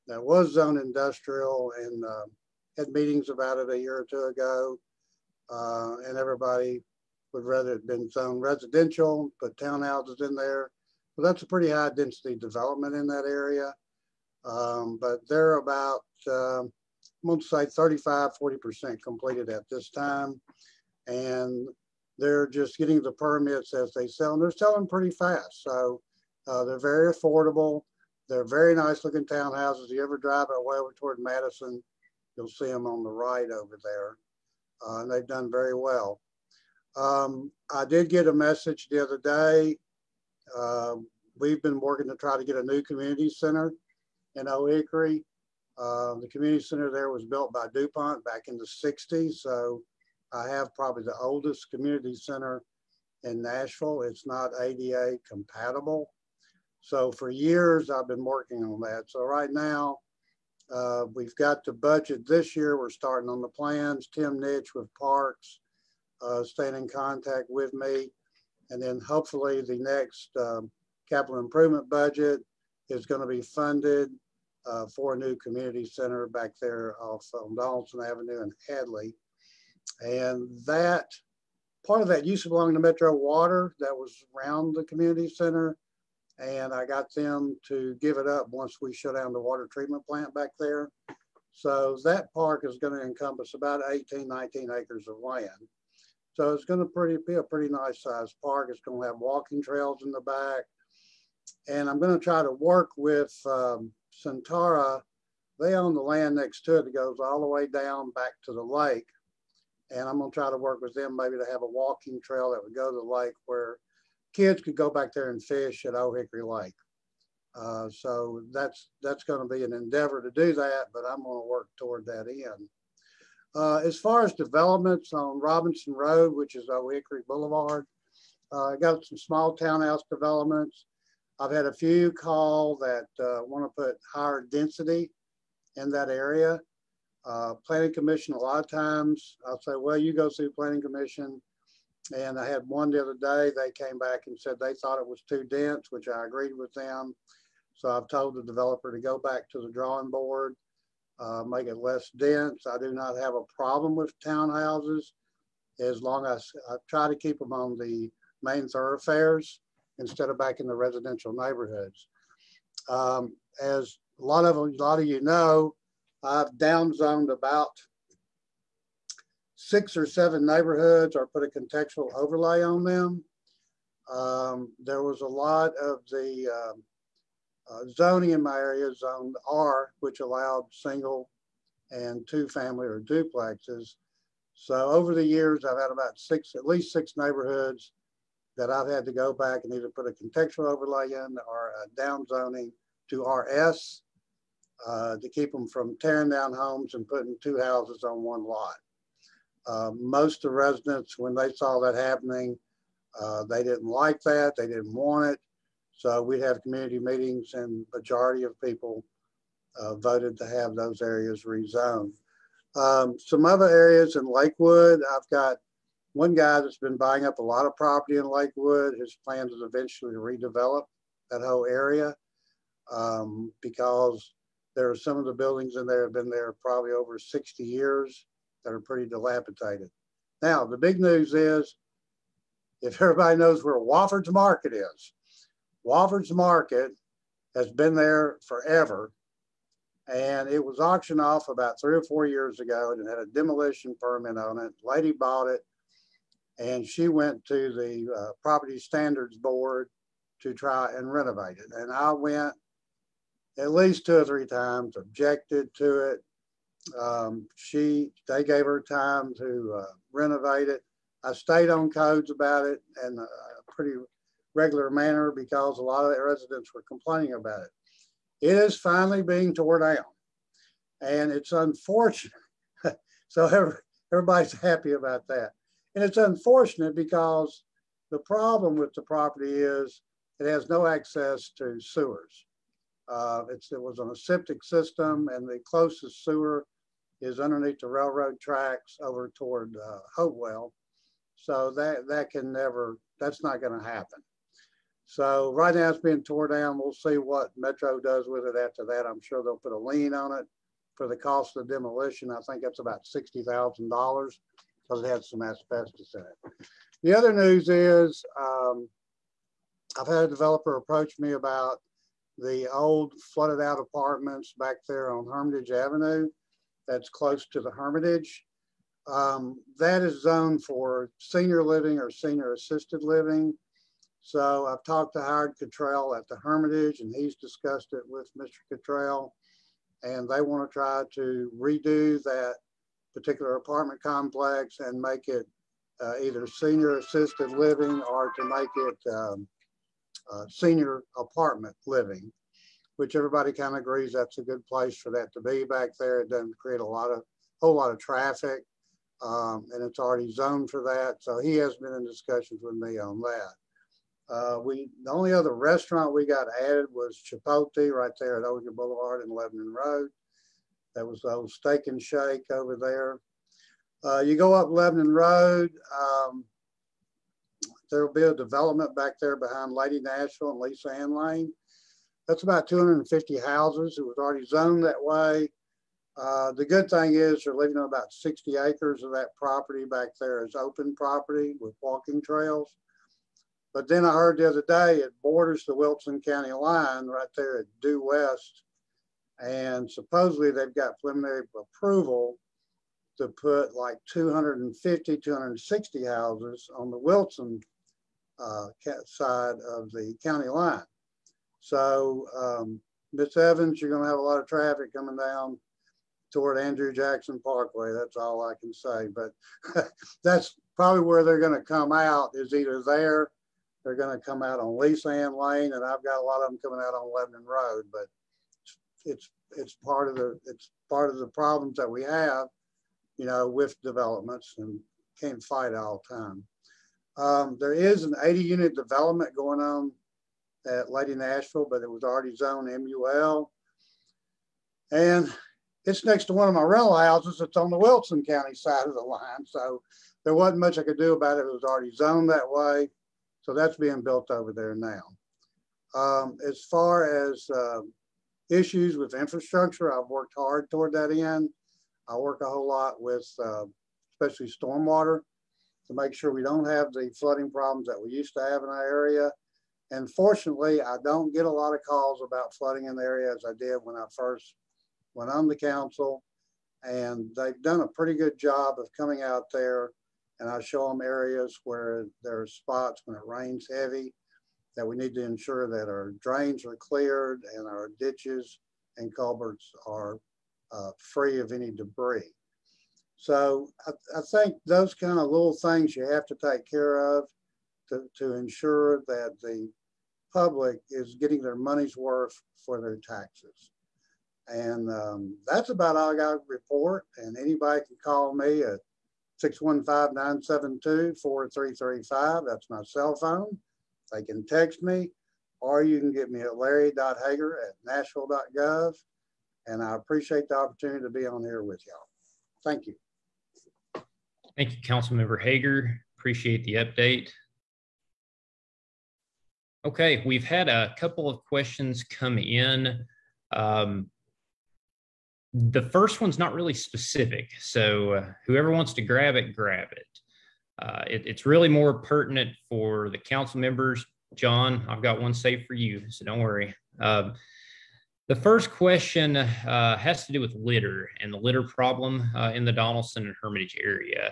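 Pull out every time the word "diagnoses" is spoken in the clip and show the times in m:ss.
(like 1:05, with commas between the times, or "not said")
not said.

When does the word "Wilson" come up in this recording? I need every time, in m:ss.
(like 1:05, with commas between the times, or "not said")
6:25, 6:36, 7:17.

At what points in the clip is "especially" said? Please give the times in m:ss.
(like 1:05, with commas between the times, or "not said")
7:34.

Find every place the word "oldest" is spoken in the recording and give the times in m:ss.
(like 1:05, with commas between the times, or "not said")
0:51.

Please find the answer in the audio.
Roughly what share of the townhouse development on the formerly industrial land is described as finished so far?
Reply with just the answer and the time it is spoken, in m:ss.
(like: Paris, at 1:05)
35-40%, at 0:17.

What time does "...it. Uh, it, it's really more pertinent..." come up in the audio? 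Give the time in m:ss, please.
8:49.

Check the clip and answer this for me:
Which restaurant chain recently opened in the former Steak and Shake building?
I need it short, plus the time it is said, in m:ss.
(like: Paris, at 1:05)
Chipotle, at 5:57.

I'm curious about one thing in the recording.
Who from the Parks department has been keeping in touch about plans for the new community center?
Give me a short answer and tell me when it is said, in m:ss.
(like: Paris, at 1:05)
Tim Netsch, at 1:04.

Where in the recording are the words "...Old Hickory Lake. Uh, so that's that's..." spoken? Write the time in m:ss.
1:55.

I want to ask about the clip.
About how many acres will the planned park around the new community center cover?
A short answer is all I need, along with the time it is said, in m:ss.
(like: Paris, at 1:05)
18-19 acres, at 1:33.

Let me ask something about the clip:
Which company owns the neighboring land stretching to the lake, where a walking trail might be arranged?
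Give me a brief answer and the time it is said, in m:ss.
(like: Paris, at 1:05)
Centara, at 1:44.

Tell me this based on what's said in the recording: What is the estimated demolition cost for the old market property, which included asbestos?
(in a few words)
$60,000.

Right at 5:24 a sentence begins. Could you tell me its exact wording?
So I've talked to Howard Kittell at the Hermitage and he's discussed it with Mr.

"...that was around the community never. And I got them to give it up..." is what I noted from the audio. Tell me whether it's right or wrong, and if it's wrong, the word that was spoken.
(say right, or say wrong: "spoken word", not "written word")
wrong: "center", not "never".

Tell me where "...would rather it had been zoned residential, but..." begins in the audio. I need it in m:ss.
0:07.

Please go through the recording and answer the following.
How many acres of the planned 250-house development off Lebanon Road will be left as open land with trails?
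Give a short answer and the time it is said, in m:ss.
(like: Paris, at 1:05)
60 acres, at 6:18.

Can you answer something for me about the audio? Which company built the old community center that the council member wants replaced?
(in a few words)
DuPont.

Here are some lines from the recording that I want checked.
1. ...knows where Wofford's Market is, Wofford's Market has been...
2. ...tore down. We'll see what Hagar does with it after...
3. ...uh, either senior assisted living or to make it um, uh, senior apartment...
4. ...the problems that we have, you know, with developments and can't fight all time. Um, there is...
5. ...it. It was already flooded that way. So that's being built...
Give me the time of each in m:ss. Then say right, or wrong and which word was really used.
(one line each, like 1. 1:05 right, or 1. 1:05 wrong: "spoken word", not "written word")
1. 3:53 right
2. 4:56 wrong: "Metro", not "Hagar"
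3. 5:36 right
4. 7:01 right
5. 7:21 wrong: "zoned", not "flooded".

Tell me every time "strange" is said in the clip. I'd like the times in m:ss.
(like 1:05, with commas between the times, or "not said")
not said.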